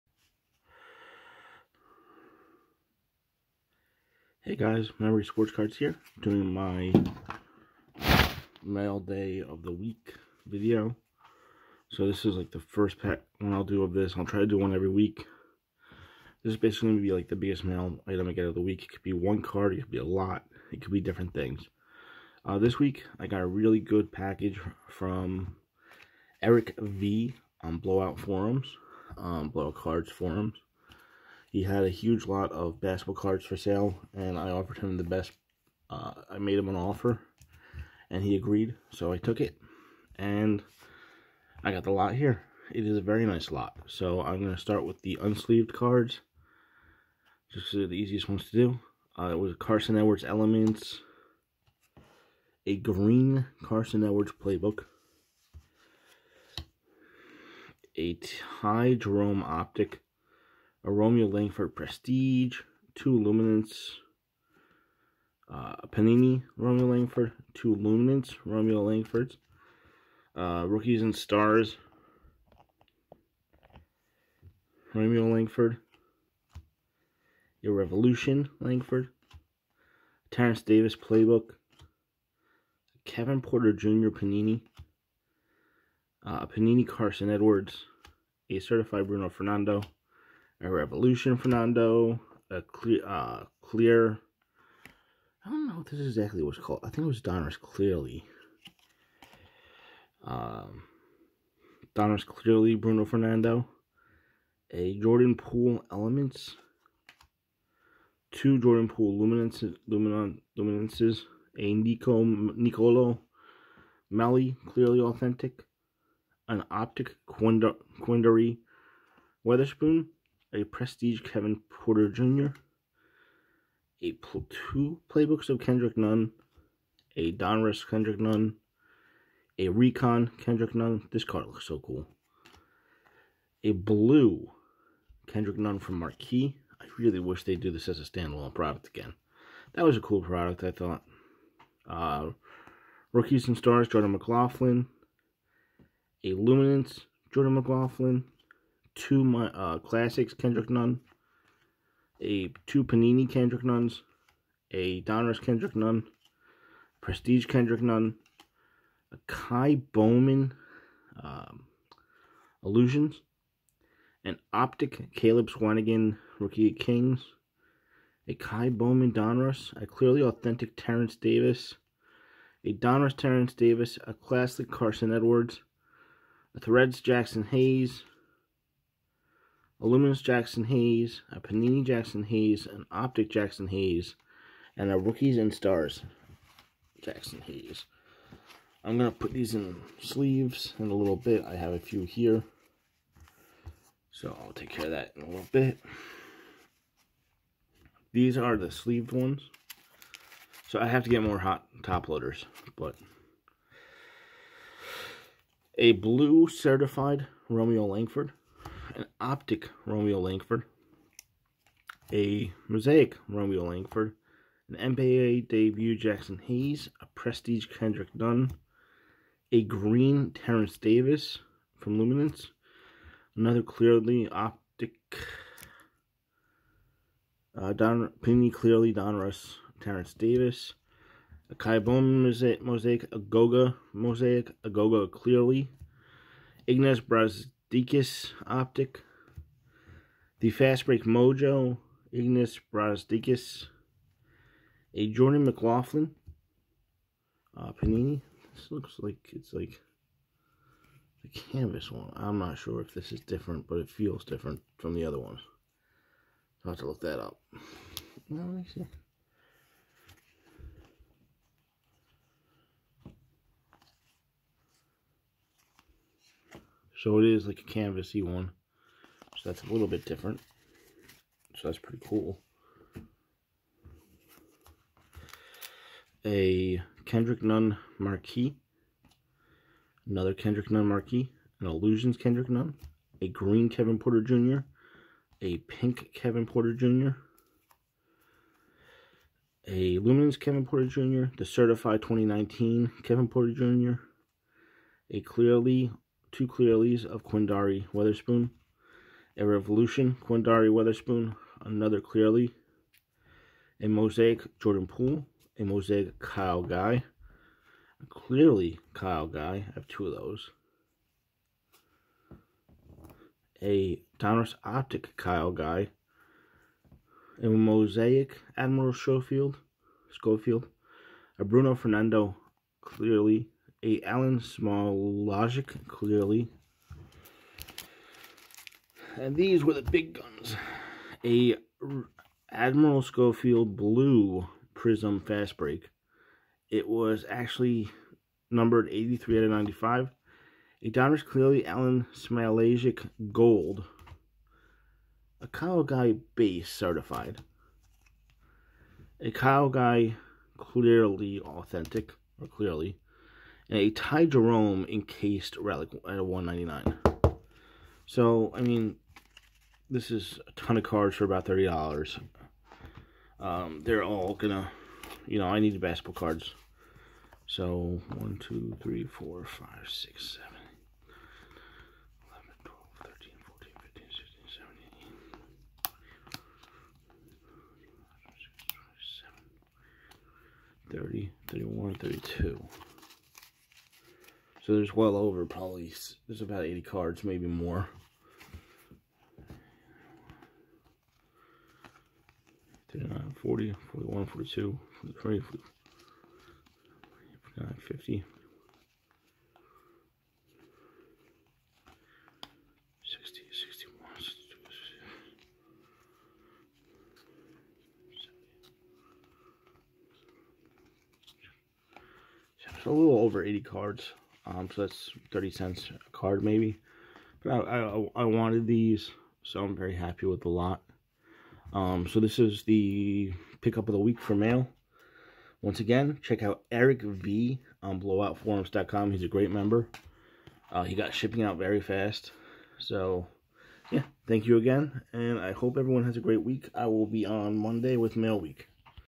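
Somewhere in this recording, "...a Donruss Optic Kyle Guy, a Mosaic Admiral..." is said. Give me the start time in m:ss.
5:13.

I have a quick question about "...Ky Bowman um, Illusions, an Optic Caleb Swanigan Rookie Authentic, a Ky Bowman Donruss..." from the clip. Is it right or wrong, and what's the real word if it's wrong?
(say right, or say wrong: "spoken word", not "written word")
wrong: "Kings", not "Authentic".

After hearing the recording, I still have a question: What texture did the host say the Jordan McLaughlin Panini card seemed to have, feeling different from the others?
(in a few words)
Canvas.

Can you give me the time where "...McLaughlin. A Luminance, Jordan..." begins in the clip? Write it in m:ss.
2:24.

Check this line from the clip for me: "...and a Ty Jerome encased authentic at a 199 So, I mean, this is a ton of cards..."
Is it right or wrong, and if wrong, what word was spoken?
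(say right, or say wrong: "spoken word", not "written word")
wrong: "relic", not "authentic".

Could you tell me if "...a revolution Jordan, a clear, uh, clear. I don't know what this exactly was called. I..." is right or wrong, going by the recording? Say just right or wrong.
wrong.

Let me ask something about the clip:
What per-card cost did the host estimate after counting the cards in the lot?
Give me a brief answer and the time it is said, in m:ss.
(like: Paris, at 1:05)
30 cents, at 6:55.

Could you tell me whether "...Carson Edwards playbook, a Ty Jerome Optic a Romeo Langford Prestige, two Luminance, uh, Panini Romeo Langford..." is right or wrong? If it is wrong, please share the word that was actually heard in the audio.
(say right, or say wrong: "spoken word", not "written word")
right.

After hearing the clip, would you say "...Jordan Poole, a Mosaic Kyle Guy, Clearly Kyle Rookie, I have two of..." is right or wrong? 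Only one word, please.
wrong.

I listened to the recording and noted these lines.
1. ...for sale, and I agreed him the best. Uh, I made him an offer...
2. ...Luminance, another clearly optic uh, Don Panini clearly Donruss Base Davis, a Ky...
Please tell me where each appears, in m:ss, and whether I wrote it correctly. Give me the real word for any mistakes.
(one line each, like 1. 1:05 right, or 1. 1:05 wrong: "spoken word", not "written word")
1. 0:33 wrong: "offered", not "agreed"
2. 3:41 wrong: "Terrence", not "Base".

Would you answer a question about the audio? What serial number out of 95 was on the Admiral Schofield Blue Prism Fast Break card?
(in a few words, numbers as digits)
83.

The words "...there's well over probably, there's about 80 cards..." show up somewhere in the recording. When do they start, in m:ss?
6:24.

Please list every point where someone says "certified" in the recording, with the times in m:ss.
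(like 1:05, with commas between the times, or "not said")
1:28, 3:26, 4:51, 5:46.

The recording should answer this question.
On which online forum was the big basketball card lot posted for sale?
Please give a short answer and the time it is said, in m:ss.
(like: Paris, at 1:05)
Blowout Cards Forums, at 0:29.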